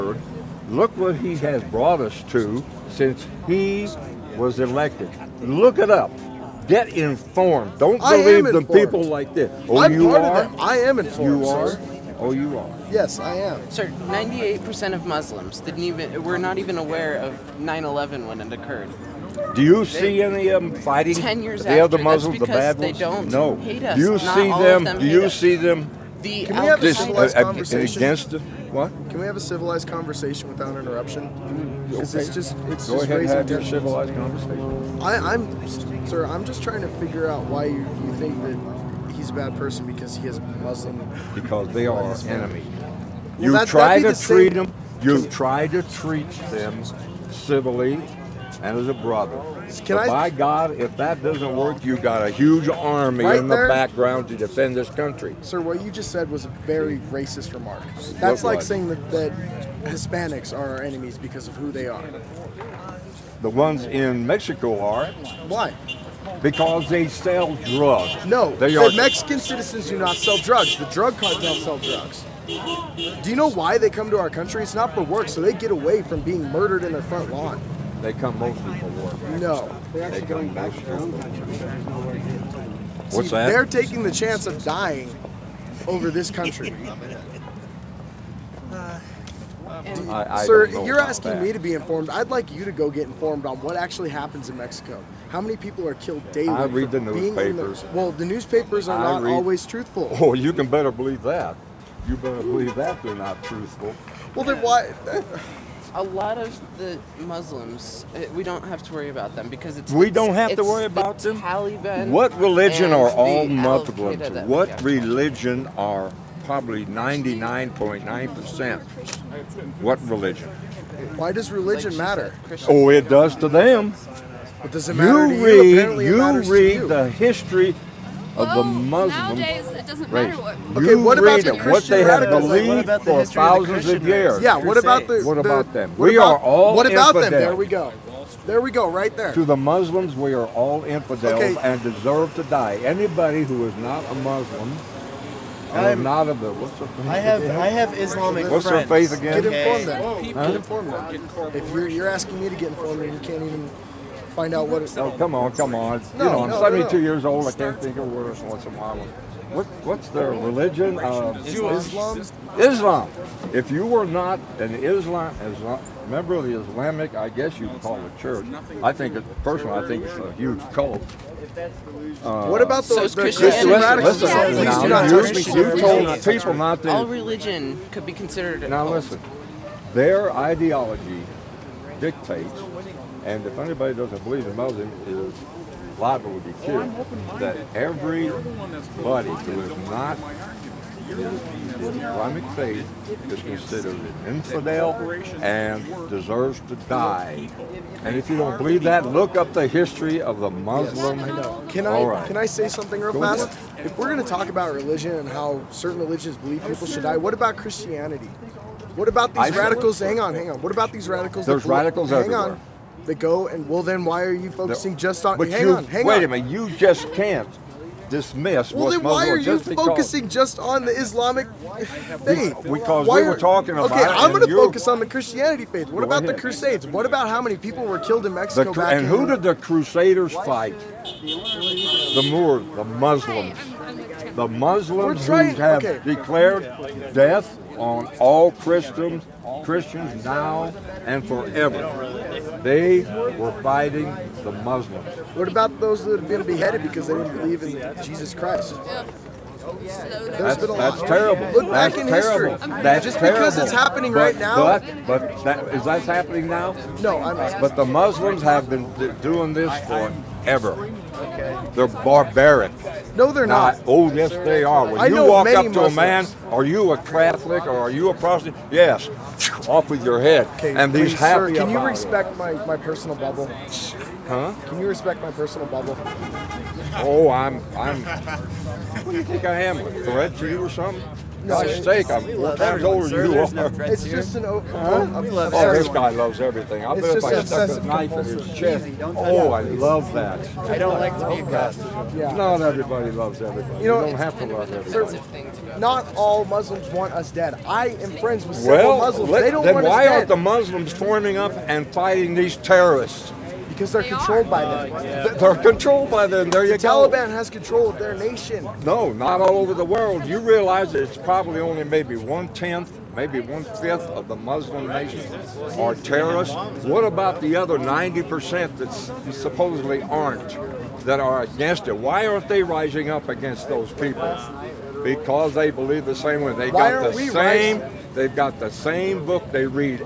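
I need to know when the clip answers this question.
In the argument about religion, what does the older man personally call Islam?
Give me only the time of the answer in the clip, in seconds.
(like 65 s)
170 s.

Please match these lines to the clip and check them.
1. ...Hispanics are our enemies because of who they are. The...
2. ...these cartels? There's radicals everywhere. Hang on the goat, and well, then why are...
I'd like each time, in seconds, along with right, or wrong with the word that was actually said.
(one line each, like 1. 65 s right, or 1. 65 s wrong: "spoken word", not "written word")
1. 59 s right
2. 210 s wrong: "radicals", not "cartels".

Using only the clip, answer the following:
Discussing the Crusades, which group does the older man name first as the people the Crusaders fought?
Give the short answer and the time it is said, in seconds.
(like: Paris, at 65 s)
The Moors, at 231 s.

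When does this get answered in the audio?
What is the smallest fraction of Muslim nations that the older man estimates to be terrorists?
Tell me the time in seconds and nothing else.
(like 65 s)
312 s.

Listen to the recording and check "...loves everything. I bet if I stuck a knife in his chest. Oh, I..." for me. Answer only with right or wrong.
right.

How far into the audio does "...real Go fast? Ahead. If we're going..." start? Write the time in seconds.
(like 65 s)
202 s.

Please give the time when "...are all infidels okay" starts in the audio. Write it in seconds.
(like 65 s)
140 s.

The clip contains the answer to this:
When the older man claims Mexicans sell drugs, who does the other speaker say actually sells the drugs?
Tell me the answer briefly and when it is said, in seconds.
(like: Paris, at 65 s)
The drug cartels, at 70 s.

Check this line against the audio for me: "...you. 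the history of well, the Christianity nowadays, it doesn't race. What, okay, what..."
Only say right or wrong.
wrong.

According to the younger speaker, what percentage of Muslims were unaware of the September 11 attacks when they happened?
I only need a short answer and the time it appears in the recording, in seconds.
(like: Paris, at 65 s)
98%, at 14 s.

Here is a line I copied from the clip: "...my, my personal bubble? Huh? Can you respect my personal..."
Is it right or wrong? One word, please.
right.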